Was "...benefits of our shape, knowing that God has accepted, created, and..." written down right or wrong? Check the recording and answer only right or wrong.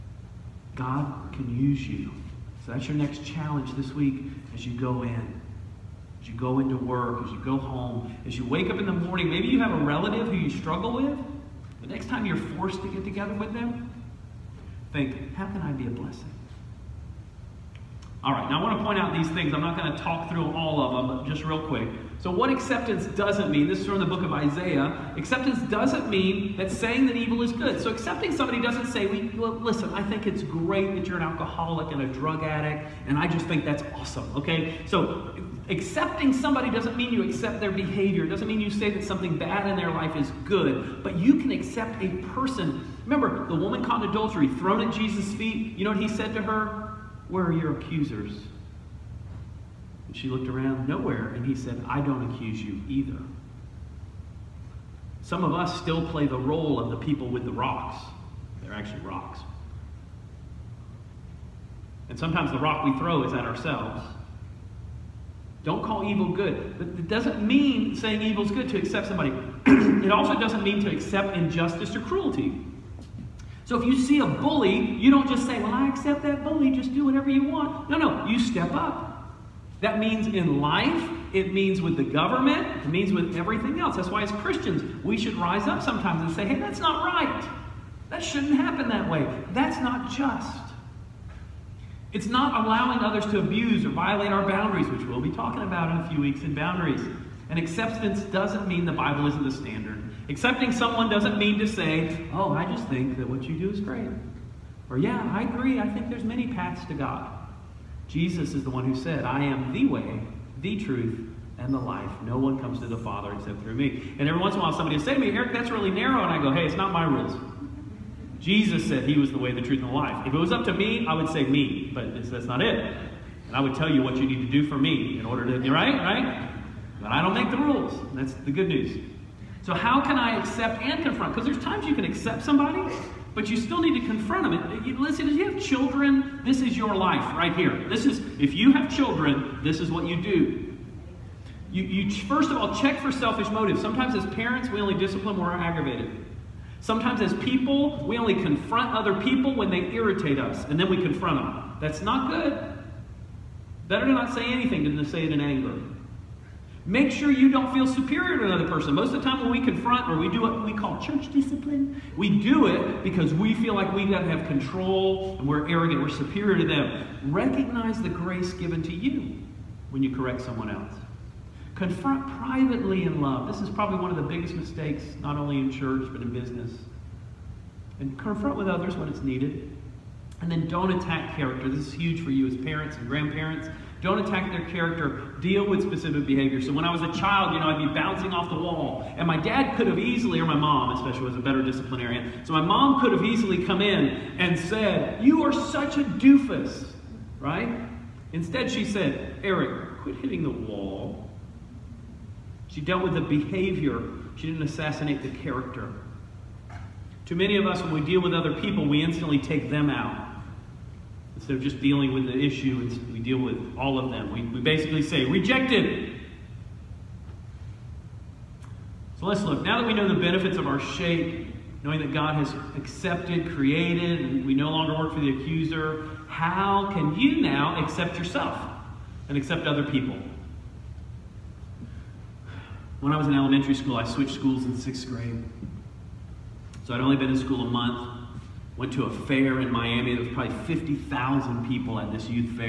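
right.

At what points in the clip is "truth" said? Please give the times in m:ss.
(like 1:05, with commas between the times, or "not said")
1:50, 1:59.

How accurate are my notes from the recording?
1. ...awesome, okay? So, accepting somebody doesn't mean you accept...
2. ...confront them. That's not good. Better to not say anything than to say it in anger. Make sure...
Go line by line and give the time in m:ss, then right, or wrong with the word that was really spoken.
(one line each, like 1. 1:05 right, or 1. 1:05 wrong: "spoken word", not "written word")
1. 0:33 right
2. 2:30 right.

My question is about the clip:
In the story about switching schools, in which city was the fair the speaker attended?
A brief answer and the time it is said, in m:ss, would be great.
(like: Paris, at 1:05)
Miami, at 3:59.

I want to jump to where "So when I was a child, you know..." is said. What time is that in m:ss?
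3:06.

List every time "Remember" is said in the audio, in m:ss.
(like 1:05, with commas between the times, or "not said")
0:43.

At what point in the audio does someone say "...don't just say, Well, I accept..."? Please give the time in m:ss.
1:15.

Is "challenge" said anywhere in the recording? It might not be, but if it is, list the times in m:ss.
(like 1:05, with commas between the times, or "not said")
0:03.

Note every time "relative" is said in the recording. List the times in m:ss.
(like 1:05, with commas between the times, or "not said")
0:09.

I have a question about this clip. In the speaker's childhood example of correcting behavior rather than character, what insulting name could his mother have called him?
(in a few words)
doofus.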